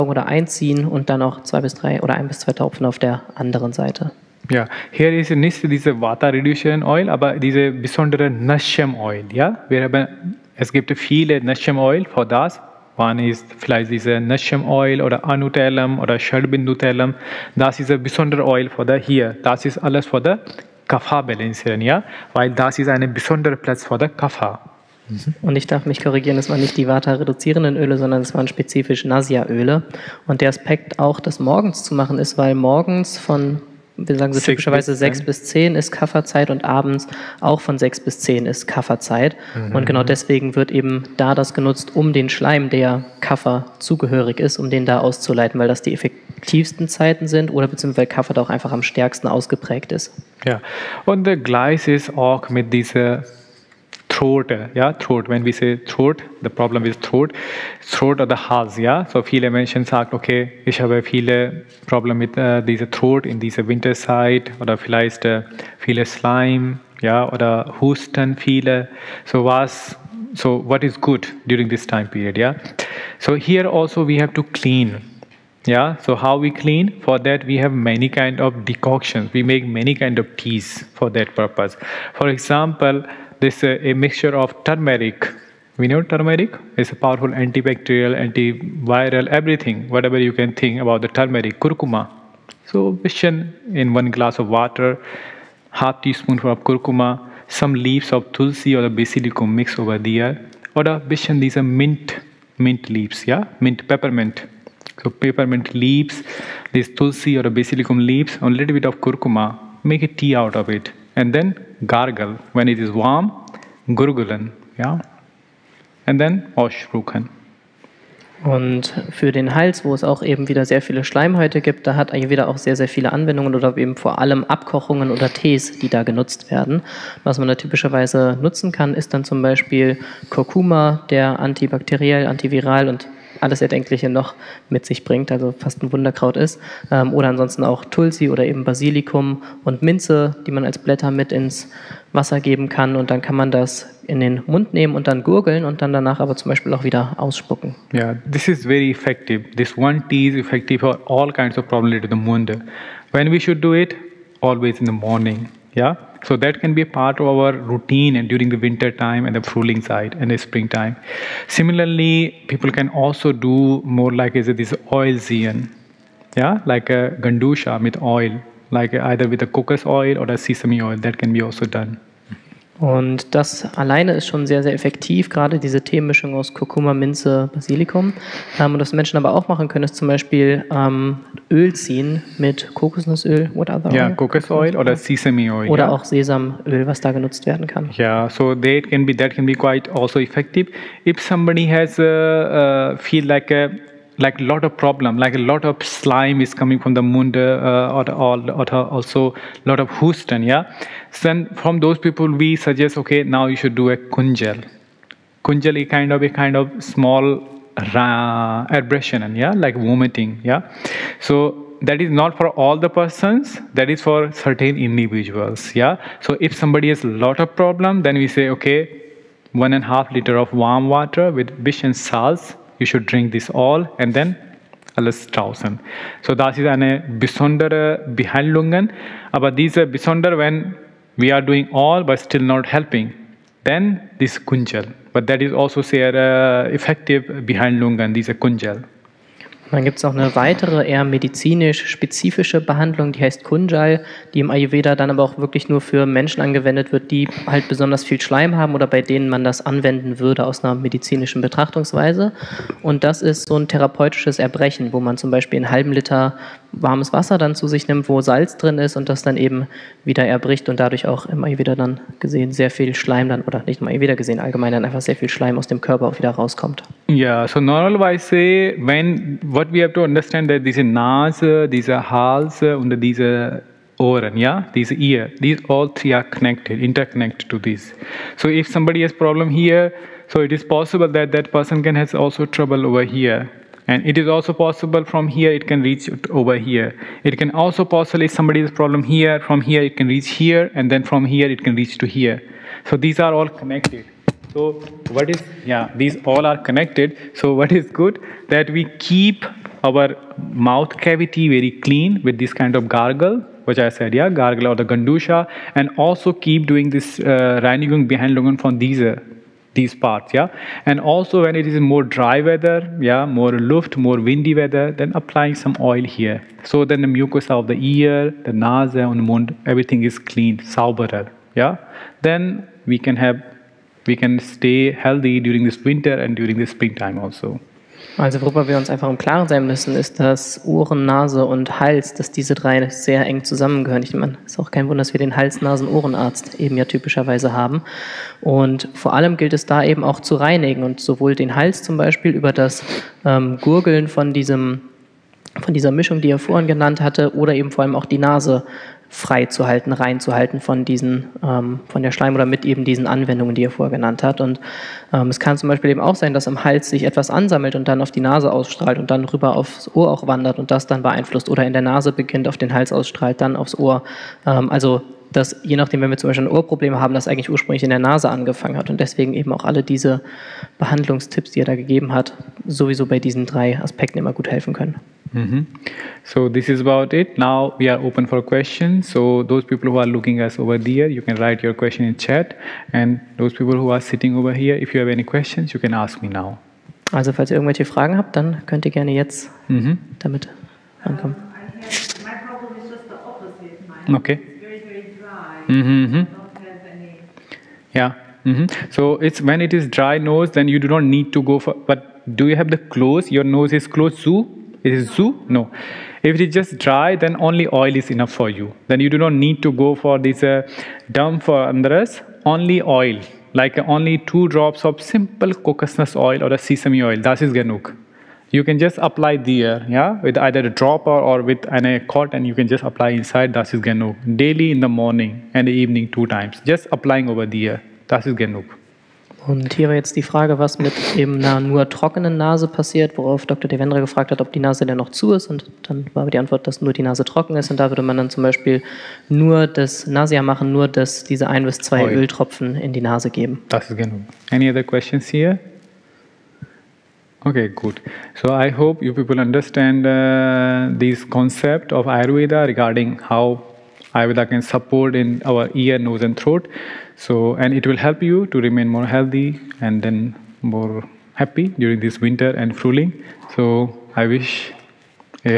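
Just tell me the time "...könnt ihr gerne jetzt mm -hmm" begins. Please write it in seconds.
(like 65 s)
388 s.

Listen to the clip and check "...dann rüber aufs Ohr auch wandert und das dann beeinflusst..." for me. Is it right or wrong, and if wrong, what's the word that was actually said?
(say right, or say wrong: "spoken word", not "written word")
right.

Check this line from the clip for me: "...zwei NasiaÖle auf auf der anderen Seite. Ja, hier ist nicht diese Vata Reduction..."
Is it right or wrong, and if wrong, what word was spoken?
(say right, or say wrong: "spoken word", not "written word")
wrong: "Tropfen", not "NasiaÖle".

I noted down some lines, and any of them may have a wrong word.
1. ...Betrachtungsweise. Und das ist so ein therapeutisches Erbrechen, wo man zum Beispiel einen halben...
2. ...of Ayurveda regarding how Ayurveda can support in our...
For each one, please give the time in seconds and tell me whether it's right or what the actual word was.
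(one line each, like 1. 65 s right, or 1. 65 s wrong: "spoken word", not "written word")
1. 251 s right
2. 451 s right.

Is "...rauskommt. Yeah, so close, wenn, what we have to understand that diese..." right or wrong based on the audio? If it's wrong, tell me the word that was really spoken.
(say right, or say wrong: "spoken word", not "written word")
wrong: "normalerweise", not "close".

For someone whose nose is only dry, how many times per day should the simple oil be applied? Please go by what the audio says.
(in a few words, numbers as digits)
2.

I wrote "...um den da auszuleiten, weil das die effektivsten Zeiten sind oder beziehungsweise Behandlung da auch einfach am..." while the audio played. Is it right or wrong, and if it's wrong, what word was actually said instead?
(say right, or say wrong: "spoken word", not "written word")
wrong: "Kaffer", not "Behandlung".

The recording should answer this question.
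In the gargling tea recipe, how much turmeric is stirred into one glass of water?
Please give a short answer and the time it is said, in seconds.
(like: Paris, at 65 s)
half teaspoon, at 95 s.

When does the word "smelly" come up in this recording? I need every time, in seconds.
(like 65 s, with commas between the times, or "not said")
not said.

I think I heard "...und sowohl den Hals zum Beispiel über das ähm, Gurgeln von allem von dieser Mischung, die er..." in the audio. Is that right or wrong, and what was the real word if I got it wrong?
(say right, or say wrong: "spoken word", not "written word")
wrong: "diesem", not "allem".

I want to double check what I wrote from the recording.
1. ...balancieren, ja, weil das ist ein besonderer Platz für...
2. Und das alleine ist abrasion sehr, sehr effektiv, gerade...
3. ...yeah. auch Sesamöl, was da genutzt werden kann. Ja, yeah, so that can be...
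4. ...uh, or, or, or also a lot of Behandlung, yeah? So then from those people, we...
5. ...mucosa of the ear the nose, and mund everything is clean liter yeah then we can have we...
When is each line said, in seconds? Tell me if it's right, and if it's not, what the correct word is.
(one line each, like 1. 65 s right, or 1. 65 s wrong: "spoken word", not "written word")
1. 21 s right
2. 172 s wrong: "schon", not "abrasion"
3. 185 s right
4. 197 s wrong: "Houston", not "Behandlung"
5. 317 s wrong: "sauberer", not "liter".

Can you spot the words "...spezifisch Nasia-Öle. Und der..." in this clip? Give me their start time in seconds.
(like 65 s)
28 s.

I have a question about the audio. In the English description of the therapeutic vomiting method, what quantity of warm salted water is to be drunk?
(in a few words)
1.5 liters.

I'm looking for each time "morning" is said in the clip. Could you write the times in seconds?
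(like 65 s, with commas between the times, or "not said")
154 s, 424 s.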